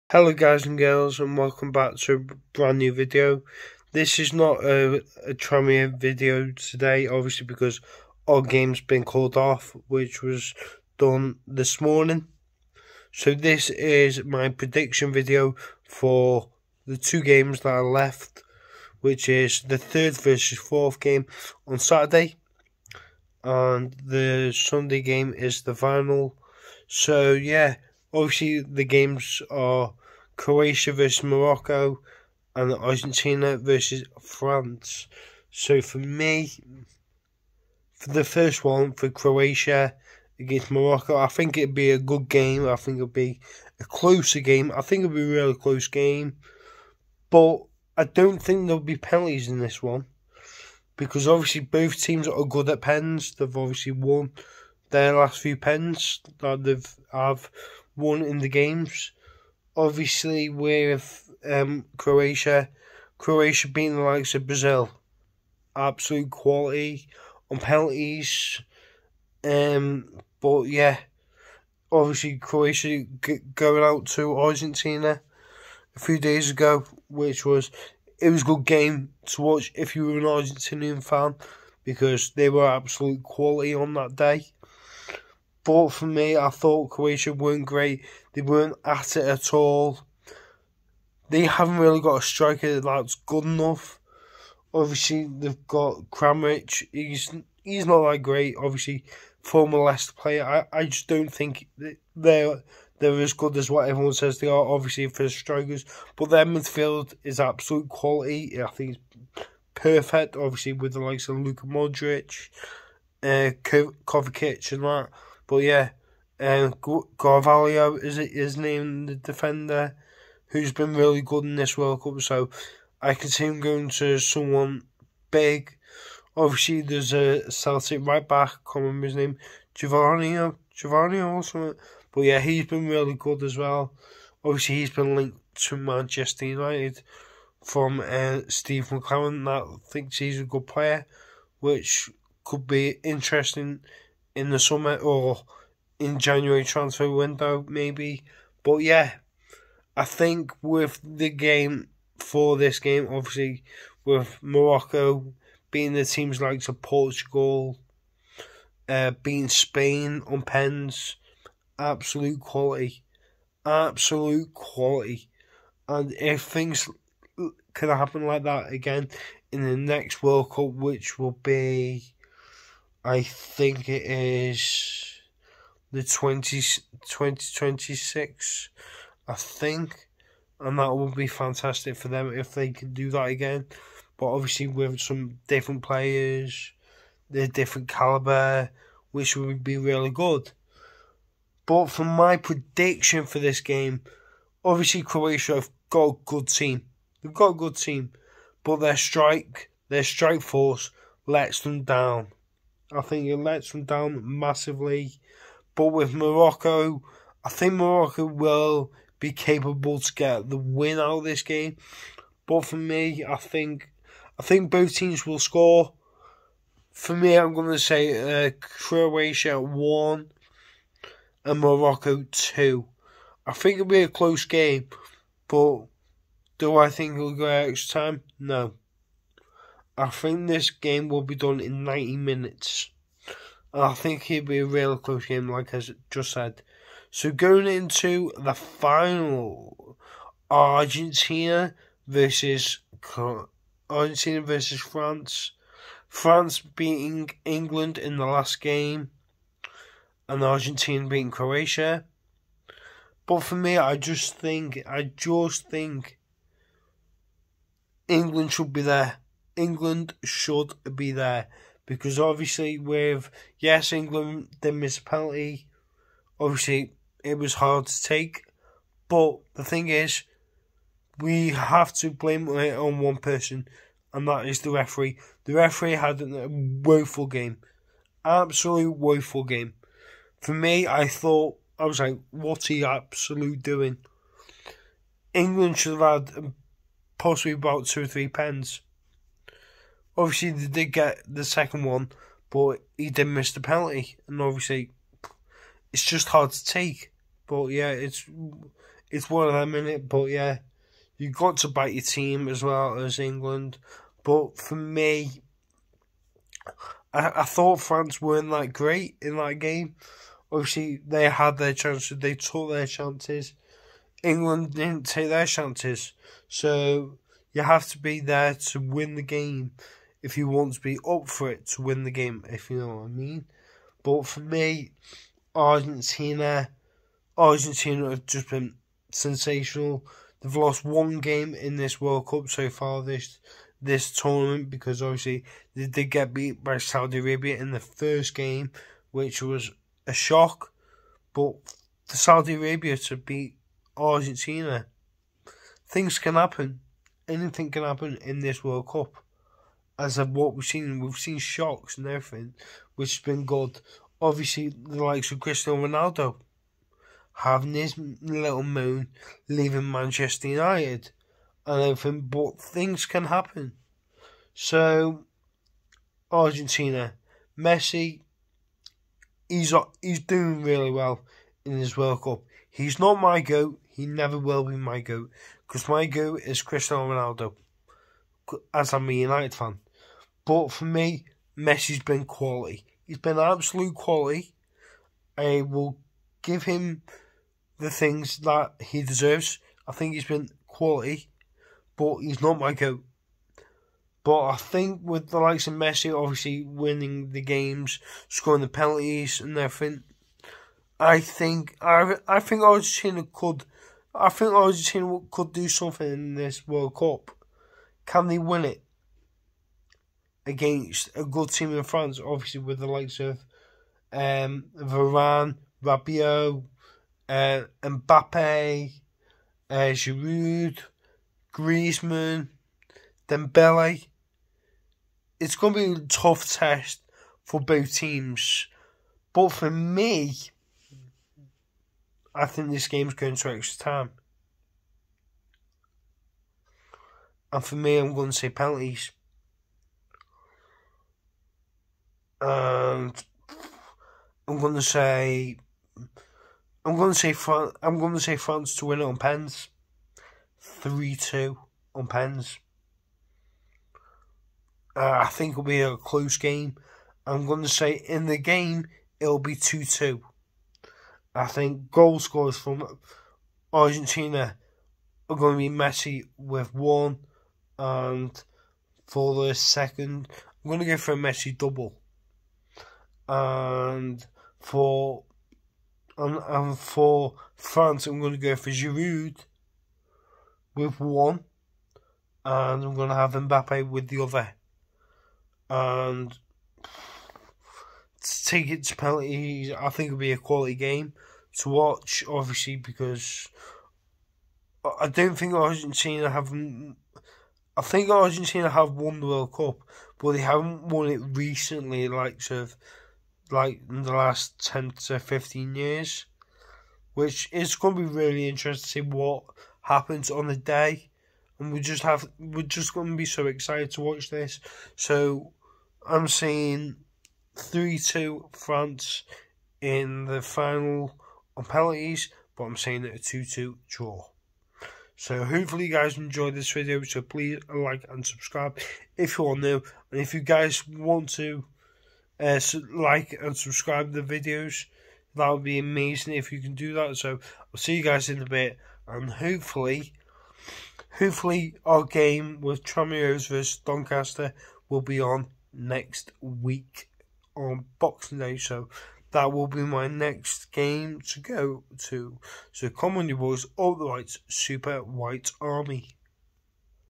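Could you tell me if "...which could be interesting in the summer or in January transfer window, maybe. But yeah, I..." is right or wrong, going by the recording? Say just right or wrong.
right.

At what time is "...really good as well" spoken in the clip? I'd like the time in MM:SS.
02:12.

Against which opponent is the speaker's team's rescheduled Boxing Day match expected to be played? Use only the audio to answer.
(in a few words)
Doncaster.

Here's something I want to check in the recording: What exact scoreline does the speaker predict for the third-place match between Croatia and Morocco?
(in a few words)
Croatia 1 Morocco 2.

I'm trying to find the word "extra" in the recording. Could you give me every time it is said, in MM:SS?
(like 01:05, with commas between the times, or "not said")
03:47, 07:13.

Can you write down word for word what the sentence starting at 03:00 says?
And that would be fantastic for them if they could do that again.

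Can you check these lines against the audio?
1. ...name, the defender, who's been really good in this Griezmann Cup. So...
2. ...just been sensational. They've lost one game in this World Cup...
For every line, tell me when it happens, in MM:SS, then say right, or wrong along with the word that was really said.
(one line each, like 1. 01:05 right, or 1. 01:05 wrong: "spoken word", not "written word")
1. 01:58 wrong: "World", not "Griezmann"
2. 05:28 right.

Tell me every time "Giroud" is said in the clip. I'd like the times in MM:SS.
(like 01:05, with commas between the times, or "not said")
06:59, 07:58.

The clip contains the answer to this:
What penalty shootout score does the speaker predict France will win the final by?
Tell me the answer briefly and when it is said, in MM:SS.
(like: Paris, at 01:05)
3-2, at 07:30.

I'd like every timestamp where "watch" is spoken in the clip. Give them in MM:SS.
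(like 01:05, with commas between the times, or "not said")
01:19, 08:11, 08:34.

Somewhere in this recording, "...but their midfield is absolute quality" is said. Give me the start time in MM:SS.
01:46.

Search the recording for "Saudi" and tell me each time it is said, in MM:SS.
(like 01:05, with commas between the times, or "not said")
05:36, 05:42.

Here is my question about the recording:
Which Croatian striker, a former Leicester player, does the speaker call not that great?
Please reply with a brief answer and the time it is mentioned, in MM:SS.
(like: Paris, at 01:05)
Kramaric, at 01:36.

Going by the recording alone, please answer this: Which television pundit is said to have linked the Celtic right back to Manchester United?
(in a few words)
Steve McClaren.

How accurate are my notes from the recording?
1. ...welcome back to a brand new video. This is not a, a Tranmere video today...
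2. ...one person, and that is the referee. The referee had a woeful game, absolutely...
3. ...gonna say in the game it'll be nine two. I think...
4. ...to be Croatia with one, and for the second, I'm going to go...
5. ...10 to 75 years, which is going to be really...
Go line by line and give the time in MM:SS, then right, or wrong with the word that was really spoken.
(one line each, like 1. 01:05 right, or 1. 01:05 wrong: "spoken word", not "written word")
1. 00:01 right
2. 04:32 right
3. 07:37 wrong: "two", not "nine"
4. 07:45 wrong: "Messi", not "Croatia"
5. 08:24 wrong: "15", not "75".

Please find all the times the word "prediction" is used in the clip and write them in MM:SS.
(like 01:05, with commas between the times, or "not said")
00:14, 03:12.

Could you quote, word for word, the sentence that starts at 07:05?
It's going to be a tough test for both teams.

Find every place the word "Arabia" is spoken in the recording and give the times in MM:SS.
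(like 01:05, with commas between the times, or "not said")
05:37, 05:42.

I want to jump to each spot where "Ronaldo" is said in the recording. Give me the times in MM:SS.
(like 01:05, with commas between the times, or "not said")
05:55, 06:17.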